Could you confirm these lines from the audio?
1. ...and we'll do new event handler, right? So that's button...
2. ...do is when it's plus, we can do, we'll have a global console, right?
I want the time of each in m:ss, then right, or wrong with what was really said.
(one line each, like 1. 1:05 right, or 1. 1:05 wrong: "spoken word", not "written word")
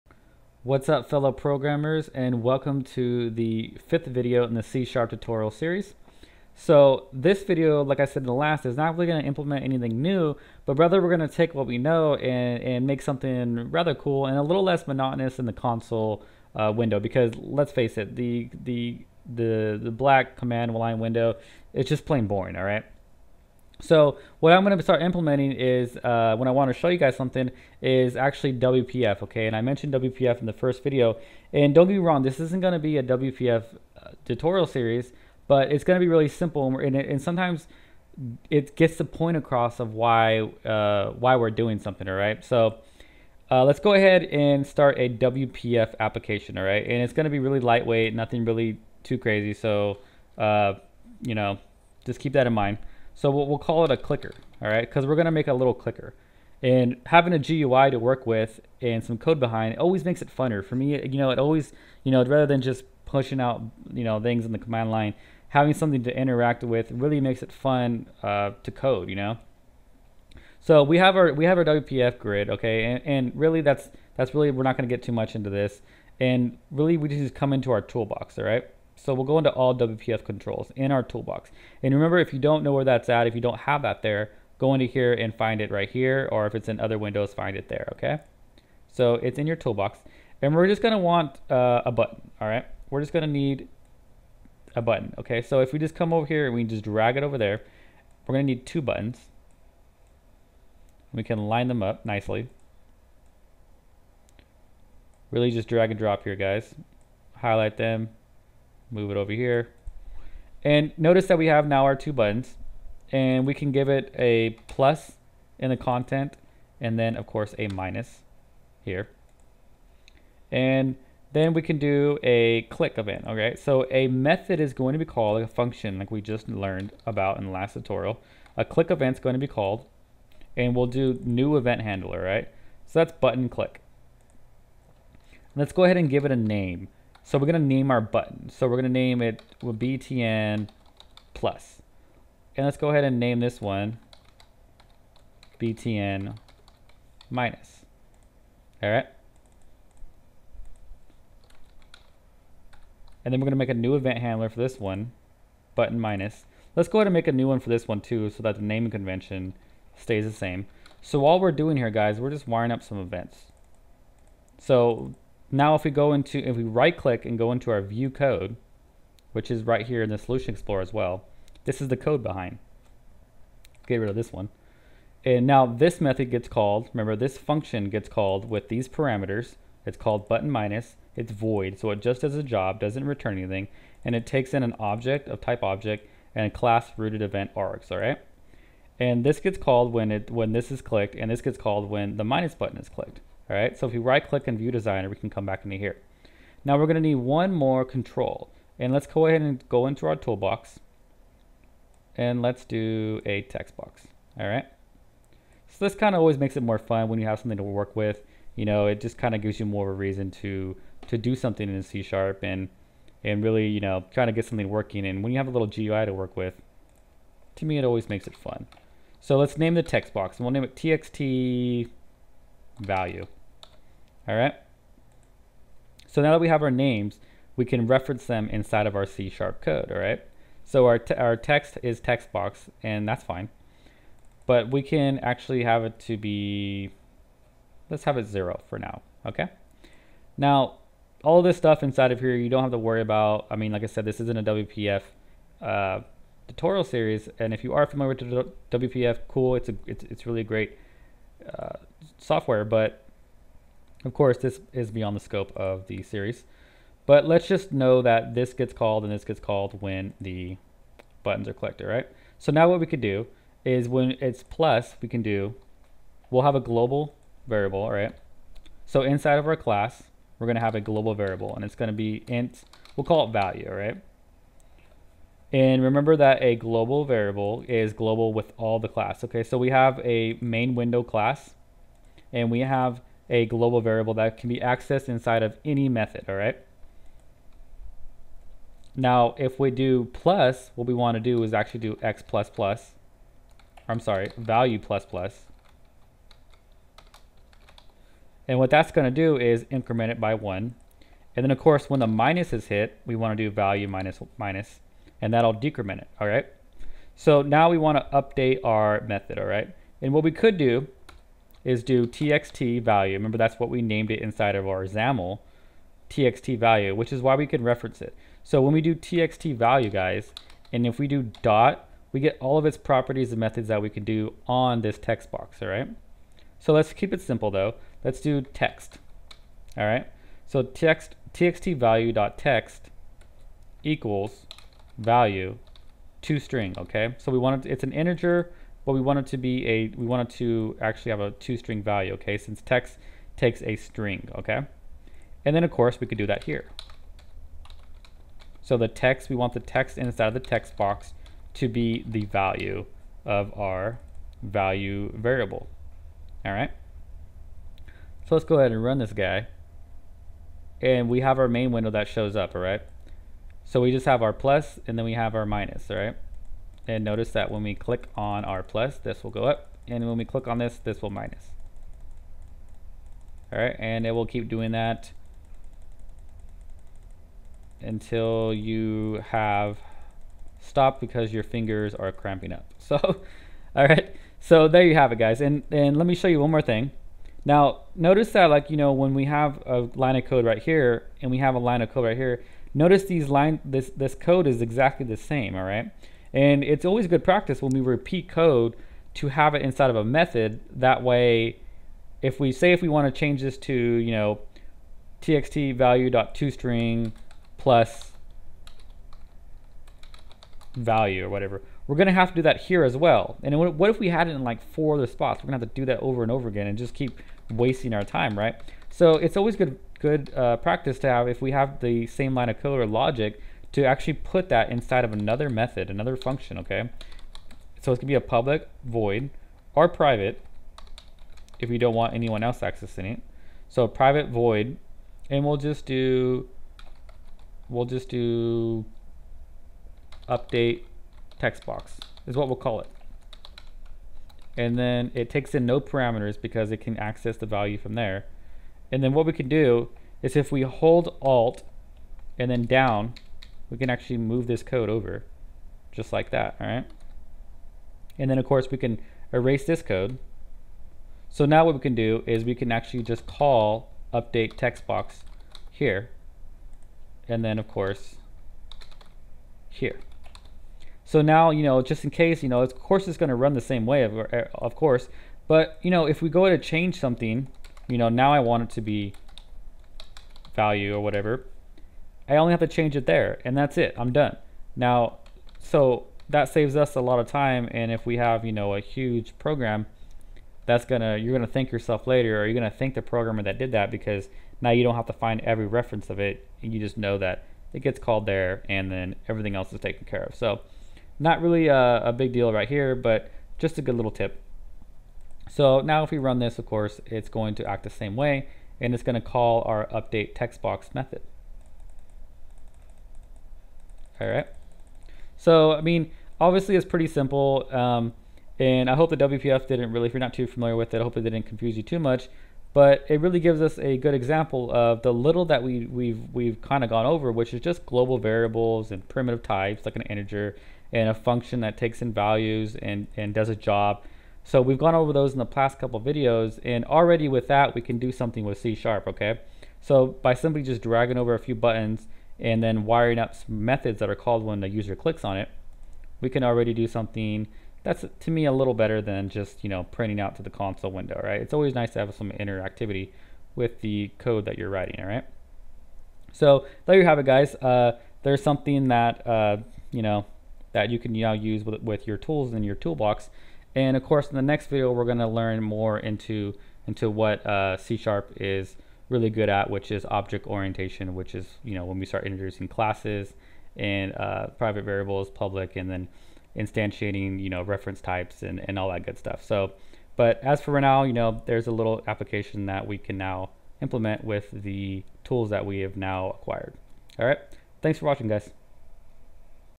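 1. 2:10 right
2. 4:23 wrong: "variable", not "console".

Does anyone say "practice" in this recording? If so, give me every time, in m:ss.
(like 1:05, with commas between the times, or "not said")
6:37, 7:00.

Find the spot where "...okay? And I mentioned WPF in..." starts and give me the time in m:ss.
0:29.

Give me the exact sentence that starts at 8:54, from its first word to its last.
So we've gone over those in the past couple videos and already with that we can do something with C sharp, okay?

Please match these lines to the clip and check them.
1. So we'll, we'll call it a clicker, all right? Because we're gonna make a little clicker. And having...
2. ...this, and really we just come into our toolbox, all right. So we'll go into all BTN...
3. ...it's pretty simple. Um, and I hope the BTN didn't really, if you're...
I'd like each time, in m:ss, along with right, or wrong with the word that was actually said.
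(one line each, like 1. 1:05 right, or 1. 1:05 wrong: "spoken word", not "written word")
1. 0:53 right
2. 1:15 wrong: "WPF", not "BTN"
3. 8:36 wrong: "WPF", not "BTN".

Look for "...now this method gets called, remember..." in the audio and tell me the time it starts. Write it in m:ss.
2:55.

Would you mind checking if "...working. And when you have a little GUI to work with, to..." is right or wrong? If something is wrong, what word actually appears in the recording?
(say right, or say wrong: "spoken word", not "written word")
right.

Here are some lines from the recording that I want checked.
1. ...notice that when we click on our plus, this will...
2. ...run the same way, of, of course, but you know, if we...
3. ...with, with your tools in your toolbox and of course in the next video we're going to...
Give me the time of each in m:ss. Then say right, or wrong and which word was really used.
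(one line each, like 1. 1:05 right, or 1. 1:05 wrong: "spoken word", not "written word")
1. 6:07 right
2. 7:53 right
3. 9:21 right.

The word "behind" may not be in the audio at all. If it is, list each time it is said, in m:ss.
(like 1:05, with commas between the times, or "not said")
0:59, 2:52.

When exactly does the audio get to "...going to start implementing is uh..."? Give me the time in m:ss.
0:24.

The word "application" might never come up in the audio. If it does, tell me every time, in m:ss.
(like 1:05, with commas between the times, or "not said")
0:45, 9:42.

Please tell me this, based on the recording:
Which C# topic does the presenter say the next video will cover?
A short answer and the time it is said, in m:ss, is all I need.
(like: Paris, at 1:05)
Object orientation, at 9:30.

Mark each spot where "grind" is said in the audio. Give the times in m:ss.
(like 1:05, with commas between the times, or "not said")
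not said.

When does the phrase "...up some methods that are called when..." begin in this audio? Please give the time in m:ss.
9:03.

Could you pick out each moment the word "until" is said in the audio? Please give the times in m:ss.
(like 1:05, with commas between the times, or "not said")
6:17.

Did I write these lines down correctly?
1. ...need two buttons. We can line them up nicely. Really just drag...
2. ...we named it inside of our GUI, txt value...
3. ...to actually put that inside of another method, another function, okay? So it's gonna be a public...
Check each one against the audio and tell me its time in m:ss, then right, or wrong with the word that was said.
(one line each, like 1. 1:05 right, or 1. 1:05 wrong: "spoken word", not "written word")
1. 1:38 right
2. 5:13 wrong: "XAML", not "GUI"
3. 7:03 right.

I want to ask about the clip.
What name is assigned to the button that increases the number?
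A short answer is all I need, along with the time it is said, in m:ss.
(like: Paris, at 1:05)
BTN plus, at 2:19.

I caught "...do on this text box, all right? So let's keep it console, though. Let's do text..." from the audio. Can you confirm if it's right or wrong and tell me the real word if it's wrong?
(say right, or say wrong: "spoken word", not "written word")
wrong: "simple", not "console".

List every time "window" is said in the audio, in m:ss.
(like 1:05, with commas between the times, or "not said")
0:16, 0:20, 1:26, 4:40, 6:01, 9:10.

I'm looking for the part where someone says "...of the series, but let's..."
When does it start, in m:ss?
4:15.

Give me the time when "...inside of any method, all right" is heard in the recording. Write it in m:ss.
4:45.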